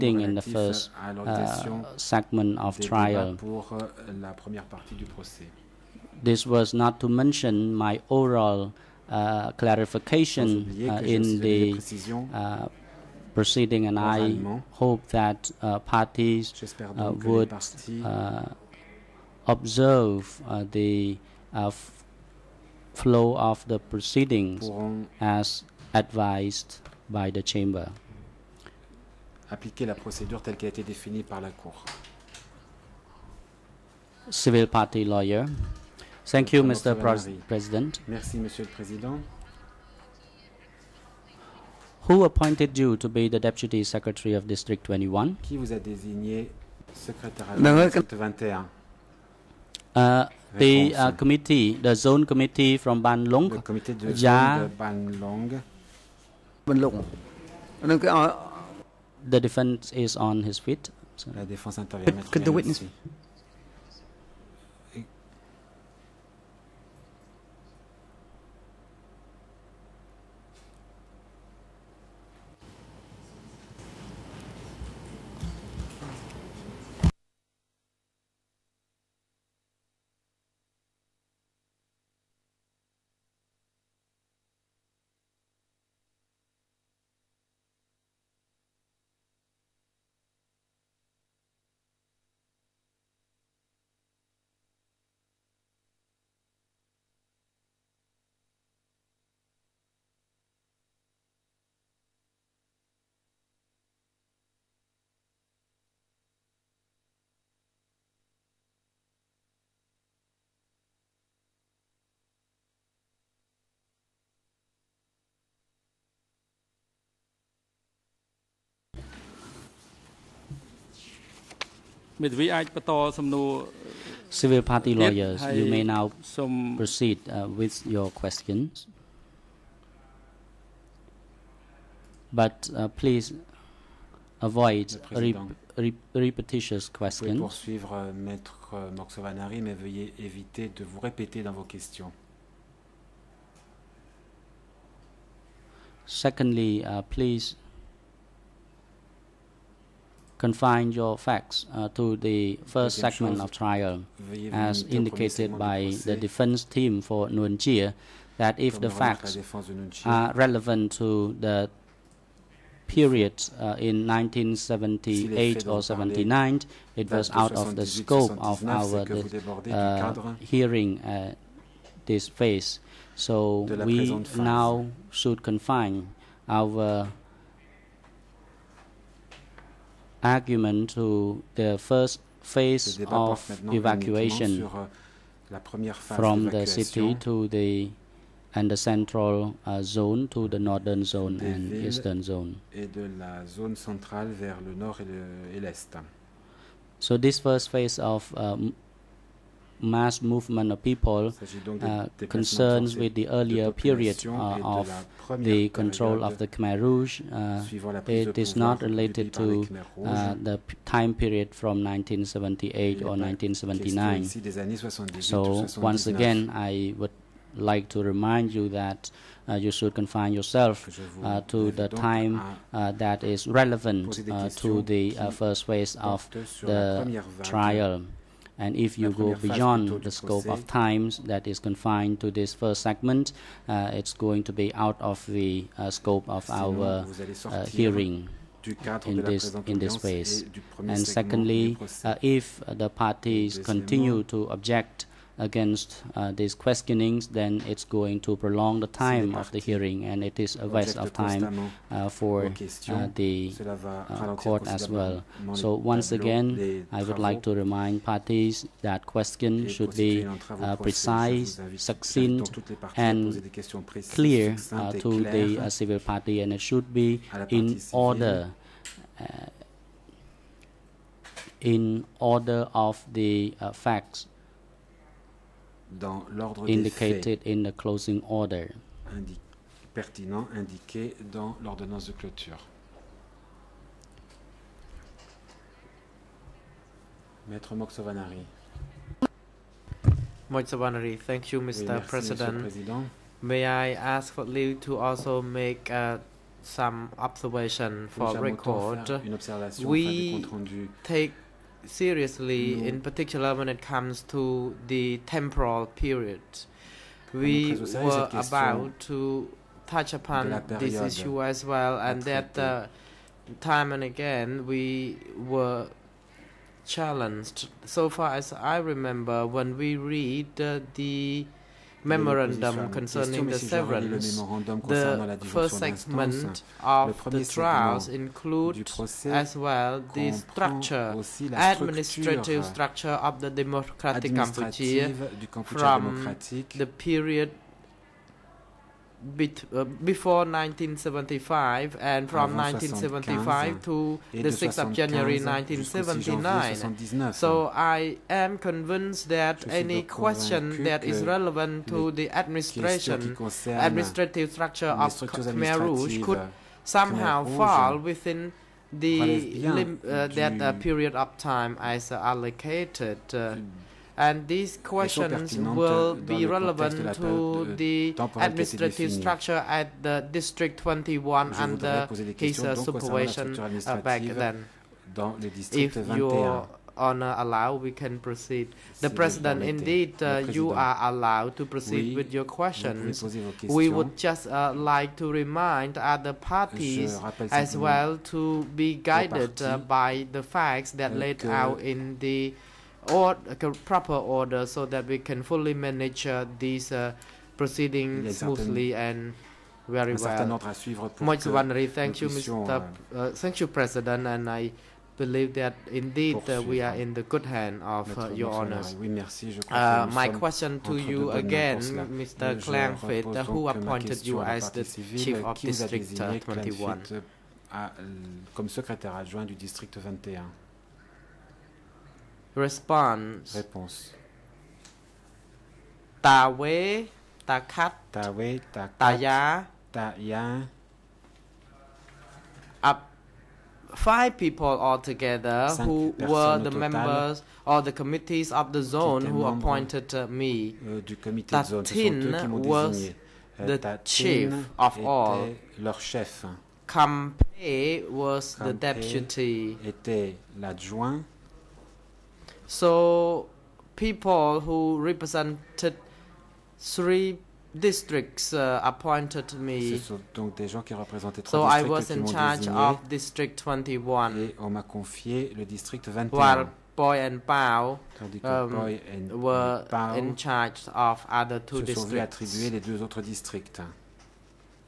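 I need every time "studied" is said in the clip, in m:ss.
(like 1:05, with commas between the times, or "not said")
not said.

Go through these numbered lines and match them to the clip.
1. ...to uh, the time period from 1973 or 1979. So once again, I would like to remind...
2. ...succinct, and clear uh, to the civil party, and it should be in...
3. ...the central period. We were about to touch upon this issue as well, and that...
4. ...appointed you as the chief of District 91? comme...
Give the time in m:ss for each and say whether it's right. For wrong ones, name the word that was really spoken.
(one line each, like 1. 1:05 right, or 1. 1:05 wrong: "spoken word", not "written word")
1. 3:29 wrong: "1978", not "1973"
2. 4:21 right
3. 5:04 wrong: "temporal", not "central"
4. 6:53 wrong: "21", not "91".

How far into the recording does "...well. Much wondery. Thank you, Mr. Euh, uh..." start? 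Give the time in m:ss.
6:40.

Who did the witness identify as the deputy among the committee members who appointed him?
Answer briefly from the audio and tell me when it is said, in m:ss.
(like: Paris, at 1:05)
Campe, at 7:26.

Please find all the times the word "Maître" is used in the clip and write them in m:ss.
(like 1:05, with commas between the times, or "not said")
2:18, 4:47.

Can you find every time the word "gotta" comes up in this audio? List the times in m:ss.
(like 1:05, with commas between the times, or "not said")
not said.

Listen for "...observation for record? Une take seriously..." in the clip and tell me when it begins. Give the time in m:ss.
4:57.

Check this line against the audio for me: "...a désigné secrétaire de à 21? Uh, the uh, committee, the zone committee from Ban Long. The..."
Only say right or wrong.
right.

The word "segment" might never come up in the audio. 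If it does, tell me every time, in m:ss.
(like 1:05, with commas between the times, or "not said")
0:01, 2:32, 3:52, 5:25.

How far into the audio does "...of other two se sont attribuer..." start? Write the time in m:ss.
7:50.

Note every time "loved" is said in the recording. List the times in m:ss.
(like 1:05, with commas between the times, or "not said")
not said.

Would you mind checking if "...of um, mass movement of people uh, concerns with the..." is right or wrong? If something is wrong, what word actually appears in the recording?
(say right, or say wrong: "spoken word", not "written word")
right.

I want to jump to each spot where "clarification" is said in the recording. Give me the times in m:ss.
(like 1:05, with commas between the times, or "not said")
0:09.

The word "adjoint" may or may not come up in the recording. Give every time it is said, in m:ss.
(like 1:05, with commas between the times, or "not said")
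6:59.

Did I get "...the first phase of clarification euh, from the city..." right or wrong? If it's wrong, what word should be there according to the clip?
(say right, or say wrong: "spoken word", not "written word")
wrong: "evacuation", not "clarification".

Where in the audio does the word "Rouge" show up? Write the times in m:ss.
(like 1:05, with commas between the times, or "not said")
3:26, 5:55.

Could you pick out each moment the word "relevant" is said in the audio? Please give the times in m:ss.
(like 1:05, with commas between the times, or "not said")
2:40, 3:43, 5:51, 6:06.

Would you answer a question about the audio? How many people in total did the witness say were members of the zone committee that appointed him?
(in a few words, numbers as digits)
5.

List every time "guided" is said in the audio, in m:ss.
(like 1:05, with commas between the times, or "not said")
6:28.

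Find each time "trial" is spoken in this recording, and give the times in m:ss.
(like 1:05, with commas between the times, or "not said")
0:02, 2:33, 3:47, 5:27.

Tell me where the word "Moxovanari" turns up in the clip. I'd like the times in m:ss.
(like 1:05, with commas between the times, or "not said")
2:18, 4:47.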